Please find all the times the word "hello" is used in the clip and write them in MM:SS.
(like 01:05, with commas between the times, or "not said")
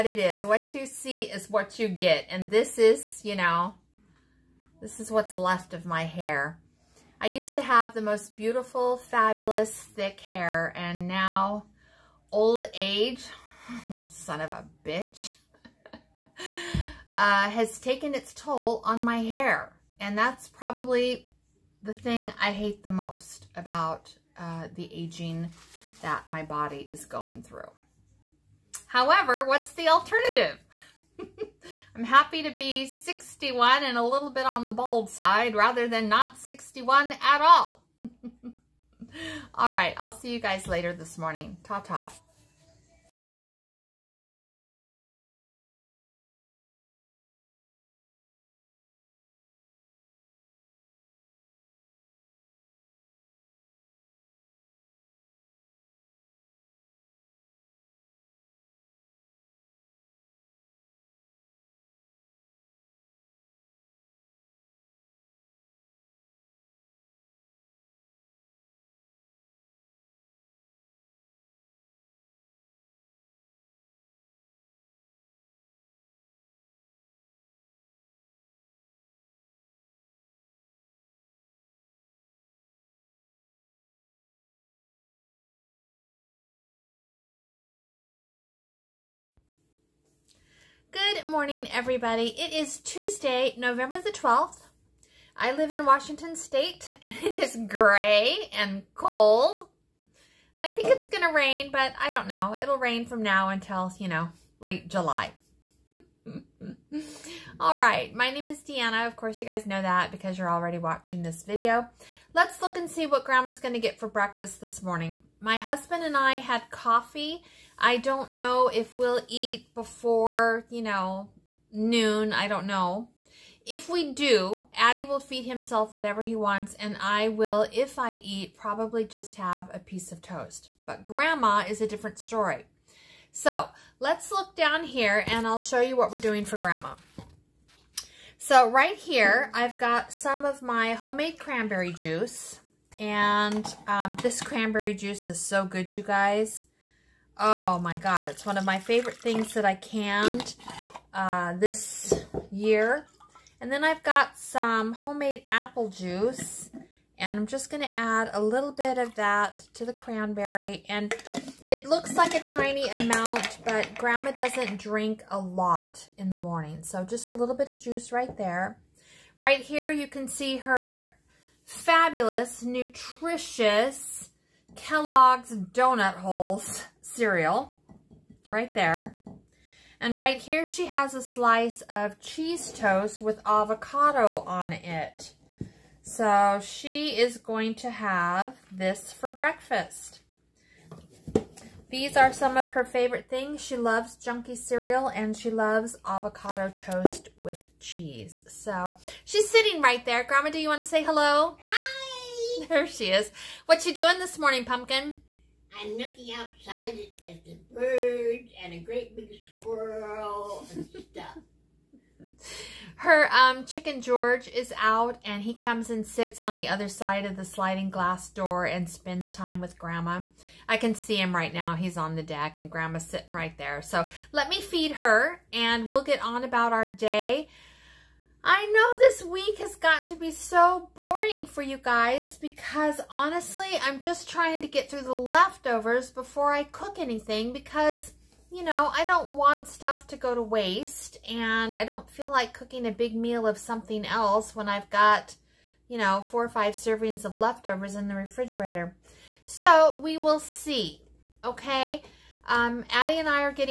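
03:21.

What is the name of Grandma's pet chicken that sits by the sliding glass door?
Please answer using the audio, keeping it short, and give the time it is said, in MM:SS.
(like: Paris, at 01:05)
George, at 03:34.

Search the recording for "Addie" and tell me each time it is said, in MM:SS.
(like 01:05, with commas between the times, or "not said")
02:04, 04:12.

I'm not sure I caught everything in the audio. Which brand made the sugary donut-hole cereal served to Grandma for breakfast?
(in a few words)
Kellogg's.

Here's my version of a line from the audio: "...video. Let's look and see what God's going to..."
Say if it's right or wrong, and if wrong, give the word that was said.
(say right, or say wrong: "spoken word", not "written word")
wrong: "Grandma", not "God".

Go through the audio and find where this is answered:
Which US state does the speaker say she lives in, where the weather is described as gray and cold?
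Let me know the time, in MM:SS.
01:35.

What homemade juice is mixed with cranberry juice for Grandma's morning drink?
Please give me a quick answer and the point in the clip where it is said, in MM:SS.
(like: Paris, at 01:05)
apple juice, at 02:35.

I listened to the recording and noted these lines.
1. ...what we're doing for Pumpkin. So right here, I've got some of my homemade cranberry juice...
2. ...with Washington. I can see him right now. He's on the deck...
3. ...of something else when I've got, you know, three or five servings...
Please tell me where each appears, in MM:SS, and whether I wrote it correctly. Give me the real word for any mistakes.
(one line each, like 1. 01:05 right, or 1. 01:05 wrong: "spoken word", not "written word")
1. 02:15 wrong: "Grandma", not "Pumpkin"
2. 03:39 wrong: "Grandma", not "Washington"
3. 04:03 wrong: "four", not "three".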